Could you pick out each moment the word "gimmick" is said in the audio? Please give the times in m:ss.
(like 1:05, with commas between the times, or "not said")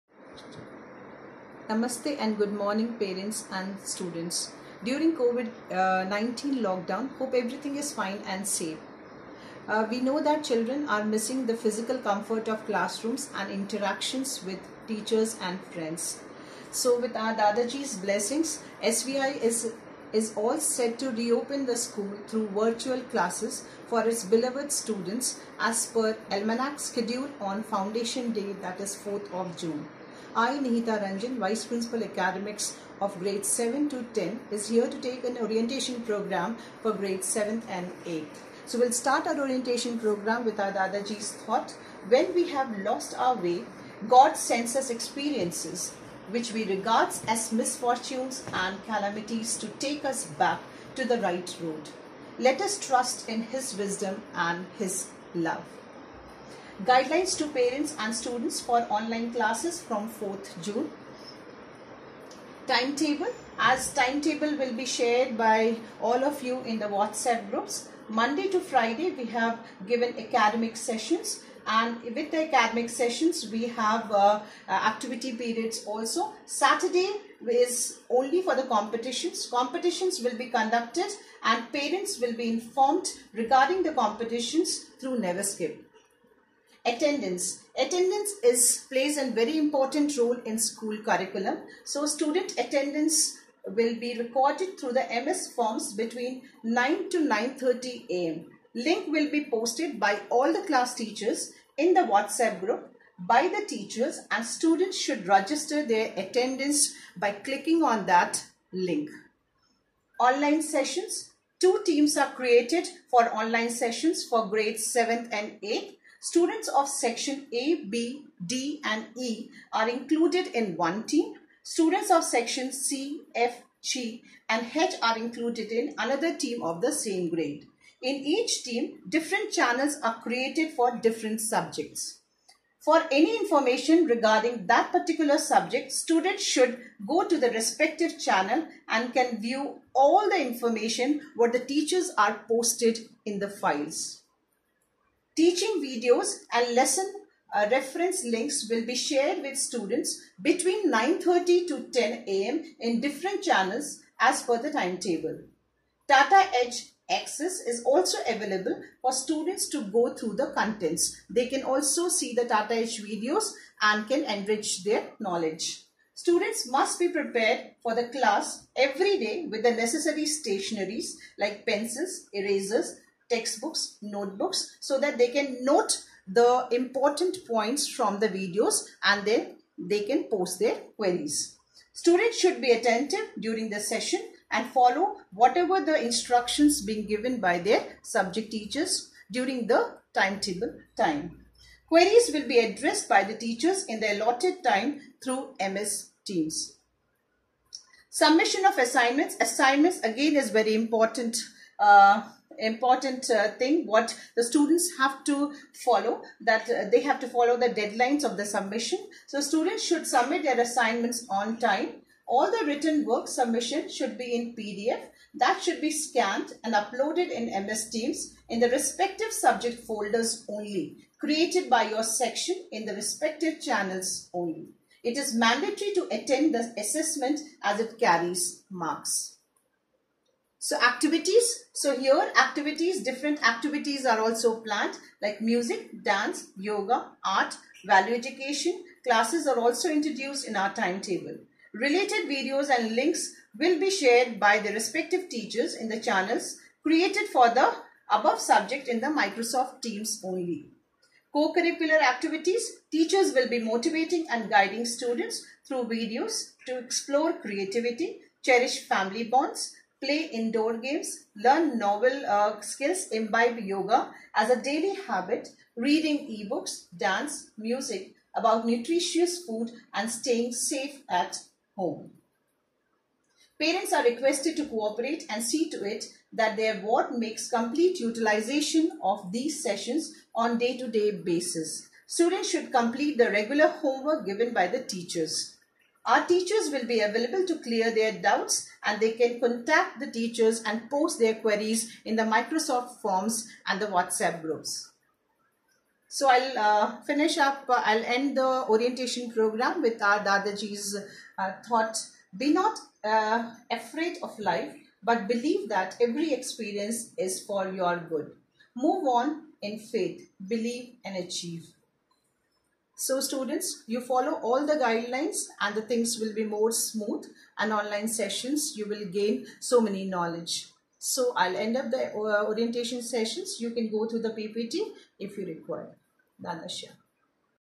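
not said.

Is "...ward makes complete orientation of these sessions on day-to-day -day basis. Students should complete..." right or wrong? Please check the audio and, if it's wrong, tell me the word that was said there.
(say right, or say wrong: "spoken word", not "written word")
wrong: "utilization", not "orientation".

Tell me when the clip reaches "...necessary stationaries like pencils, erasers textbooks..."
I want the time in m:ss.
2:49.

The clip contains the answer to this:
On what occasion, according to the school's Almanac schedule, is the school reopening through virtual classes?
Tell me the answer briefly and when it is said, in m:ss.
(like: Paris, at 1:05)
Foundation Day, at 0:27.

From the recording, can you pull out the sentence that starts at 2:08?
In each team, different channels are created for different subjects.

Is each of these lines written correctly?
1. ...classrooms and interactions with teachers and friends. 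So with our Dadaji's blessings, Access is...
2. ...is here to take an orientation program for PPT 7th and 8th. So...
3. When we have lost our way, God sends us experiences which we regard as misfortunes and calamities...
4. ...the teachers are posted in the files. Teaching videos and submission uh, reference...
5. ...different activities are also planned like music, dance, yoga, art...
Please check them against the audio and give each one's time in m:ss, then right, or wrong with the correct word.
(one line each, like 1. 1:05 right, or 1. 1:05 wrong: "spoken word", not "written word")
1. 0:12 wrong: "SVI", not "Access"
2. 0:34 wrong: "Grade", not "PPT"
3. 0:42 right
4. 2:21 wrong: "lesson", not "submission"
5. 3:53 right.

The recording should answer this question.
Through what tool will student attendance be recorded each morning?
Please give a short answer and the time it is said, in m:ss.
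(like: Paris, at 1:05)
MS Forms, at 1:35.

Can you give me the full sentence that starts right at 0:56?
Guidelines to parents and students for online classes from 4th June.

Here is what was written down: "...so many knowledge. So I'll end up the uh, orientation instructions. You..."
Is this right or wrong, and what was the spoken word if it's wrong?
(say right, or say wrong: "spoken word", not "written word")
wrong: "sessions", not "instructions".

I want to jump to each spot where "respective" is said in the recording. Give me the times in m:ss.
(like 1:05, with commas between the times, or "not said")
2:17, 3:38, 3:42, 4:04.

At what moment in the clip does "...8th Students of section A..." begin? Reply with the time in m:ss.
1:55.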